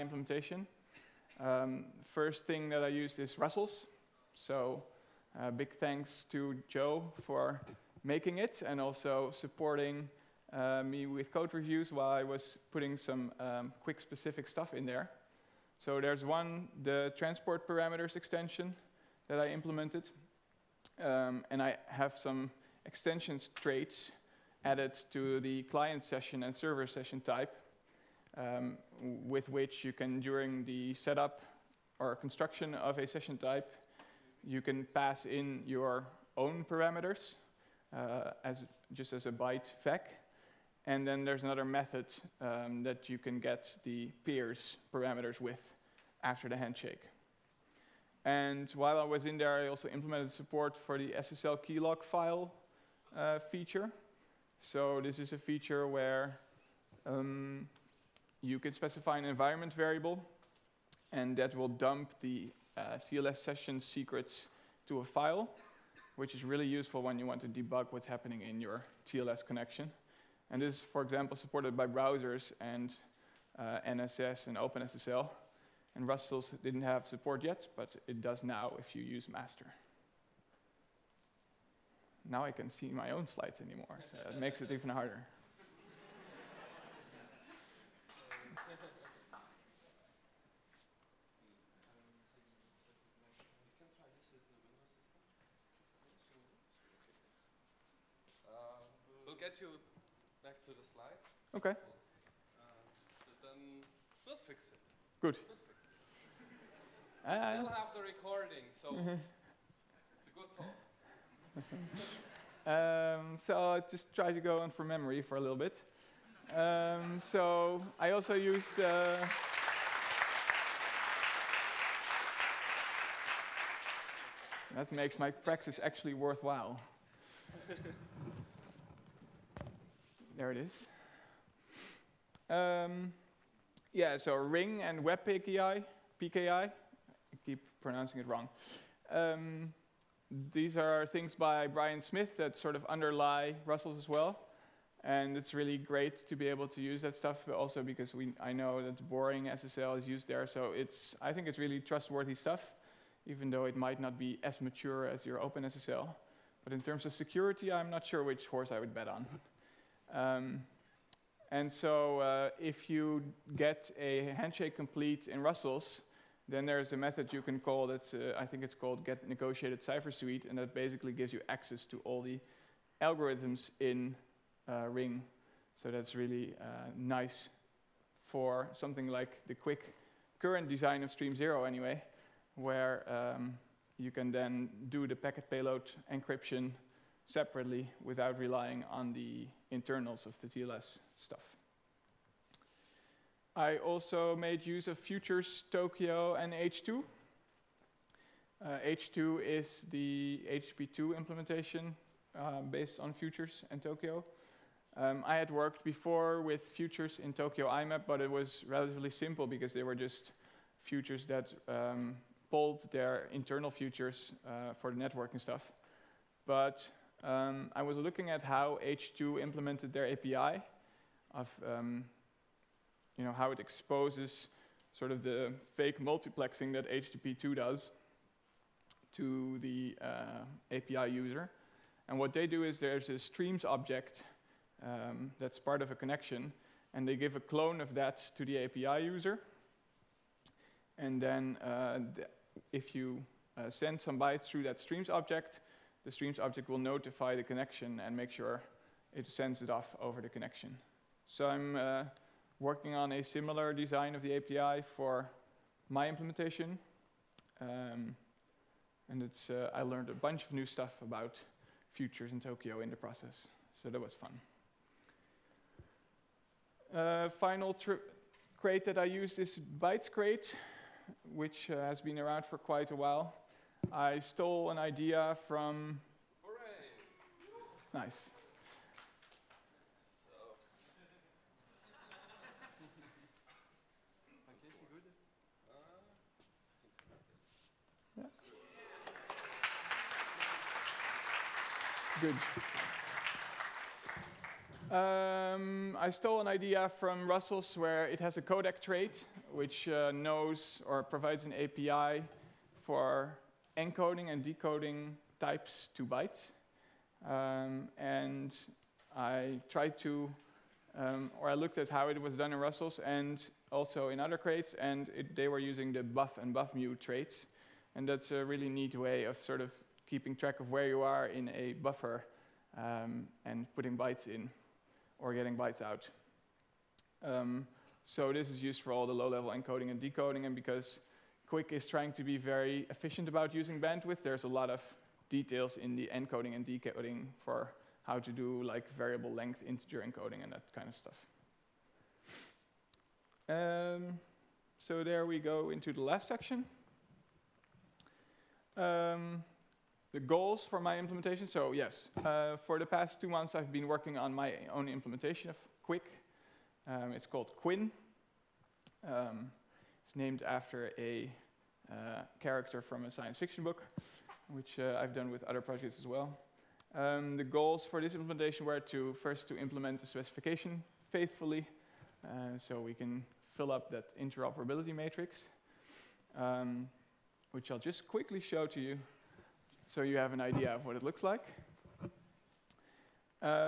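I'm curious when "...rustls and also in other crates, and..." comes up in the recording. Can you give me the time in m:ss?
5:12.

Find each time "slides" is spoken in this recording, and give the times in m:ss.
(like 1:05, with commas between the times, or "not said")
1:23, 1:40.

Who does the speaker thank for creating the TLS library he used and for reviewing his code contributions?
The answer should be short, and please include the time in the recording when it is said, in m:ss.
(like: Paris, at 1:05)
Joe, at 0:06.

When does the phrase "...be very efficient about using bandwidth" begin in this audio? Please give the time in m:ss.
5:32.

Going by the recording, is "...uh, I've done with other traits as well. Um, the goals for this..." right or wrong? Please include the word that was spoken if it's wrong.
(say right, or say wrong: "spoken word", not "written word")
wrong: "projects", not "traits".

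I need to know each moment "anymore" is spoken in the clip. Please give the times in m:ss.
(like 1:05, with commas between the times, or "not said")
1:23.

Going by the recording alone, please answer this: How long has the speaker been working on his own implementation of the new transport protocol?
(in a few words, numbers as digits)
two months.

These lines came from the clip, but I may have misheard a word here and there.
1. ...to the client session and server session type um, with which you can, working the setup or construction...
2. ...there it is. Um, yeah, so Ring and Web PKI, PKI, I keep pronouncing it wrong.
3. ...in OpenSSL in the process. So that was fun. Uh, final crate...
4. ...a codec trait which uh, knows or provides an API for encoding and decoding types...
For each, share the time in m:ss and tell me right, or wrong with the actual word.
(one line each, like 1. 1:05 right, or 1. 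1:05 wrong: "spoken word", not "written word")
1. 0:25 wrong: "during", not "working"
2. 2:10 right
3. 4:22 wrong: "Tokio", not "OpenSSL"
4. 4:58 right.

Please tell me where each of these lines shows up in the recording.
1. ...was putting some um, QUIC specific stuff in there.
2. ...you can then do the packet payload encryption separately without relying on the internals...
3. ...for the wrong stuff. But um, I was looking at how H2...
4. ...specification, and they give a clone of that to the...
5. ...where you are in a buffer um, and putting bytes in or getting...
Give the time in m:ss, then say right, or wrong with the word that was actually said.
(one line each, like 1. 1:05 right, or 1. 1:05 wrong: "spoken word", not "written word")
1. 0:12 right
2. 3:03 right
3. 3:34 wrong: "networking", not "wrong"
4. 3:55 wrong: "connection", not "specification"
5. 5:20 right.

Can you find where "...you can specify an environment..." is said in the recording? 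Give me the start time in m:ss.
0:58.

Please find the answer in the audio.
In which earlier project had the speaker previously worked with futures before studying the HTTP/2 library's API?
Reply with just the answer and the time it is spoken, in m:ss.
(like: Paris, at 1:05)
Tokio IMAP, at 3:27.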